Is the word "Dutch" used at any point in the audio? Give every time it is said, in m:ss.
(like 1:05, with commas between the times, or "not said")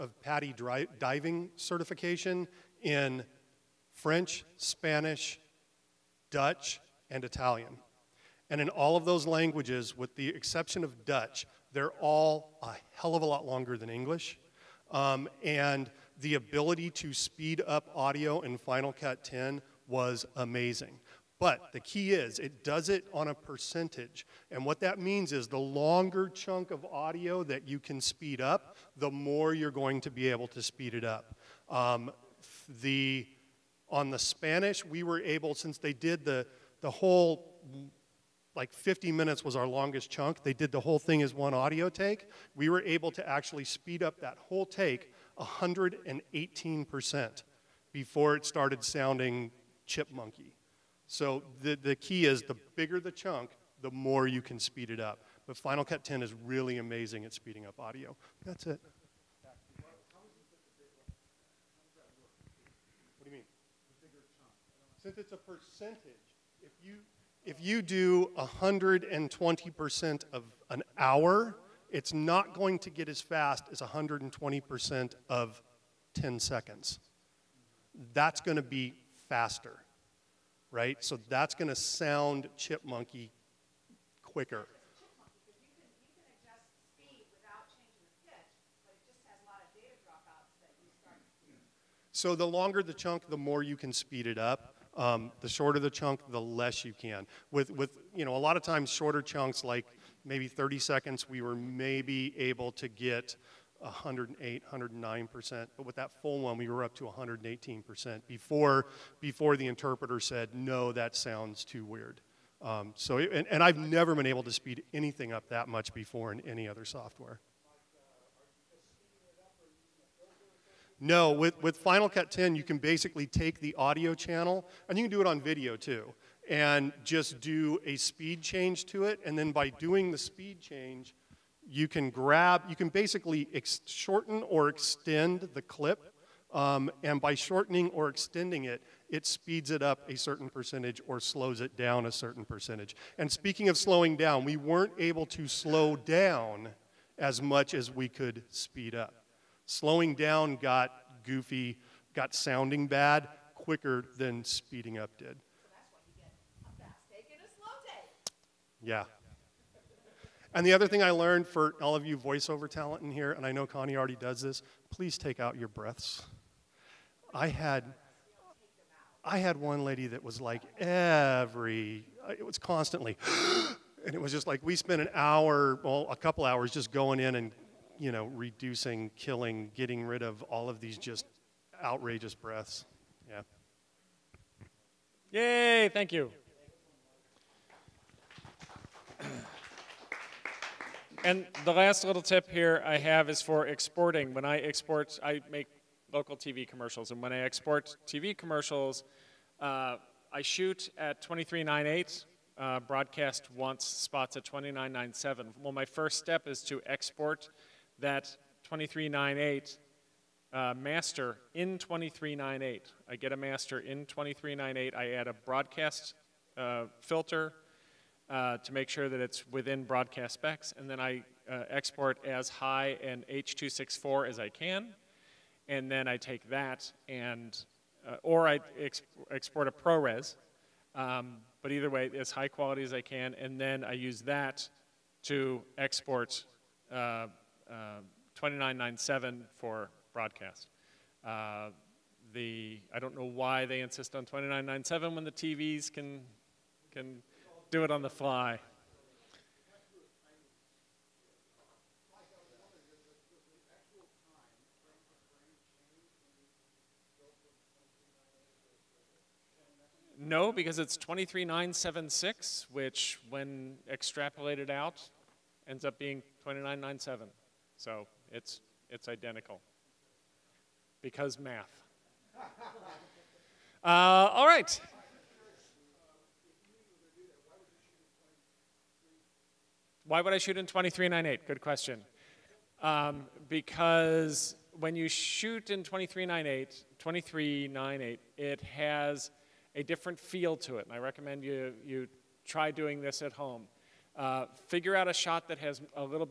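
0:06, 0:11.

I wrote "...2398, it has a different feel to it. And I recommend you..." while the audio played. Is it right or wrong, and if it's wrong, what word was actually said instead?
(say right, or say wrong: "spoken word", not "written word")
right.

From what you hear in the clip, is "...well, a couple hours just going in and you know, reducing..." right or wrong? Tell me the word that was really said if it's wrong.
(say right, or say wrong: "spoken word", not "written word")
right.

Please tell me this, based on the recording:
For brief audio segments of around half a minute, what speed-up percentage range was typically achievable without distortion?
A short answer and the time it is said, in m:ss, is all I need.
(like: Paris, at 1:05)
108, 109%, at 1:43.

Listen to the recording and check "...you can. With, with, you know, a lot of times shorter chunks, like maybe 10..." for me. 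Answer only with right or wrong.
wrong.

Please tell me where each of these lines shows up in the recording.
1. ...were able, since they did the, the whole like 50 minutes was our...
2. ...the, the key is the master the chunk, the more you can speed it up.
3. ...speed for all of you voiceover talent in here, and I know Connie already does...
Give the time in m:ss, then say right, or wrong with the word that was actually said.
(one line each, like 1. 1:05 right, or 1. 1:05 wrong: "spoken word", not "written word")
1. 0:35 right
2. 0:51 wrong: "bigger", not "master"
3. 2:41 wrong: "learned", not "speed".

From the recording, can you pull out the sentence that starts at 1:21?
So that's going to sound chipmunky quicker.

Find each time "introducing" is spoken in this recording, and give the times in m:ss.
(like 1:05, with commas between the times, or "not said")
not said.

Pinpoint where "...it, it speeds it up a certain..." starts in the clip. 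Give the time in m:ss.
2:18.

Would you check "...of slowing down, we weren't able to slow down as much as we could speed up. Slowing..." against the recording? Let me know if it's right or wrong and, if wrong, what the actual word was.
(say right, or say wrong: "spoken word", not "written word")
right.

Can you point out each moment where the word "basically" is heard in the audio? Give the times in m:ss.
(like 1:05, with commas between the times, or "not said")
2:02, 2:12.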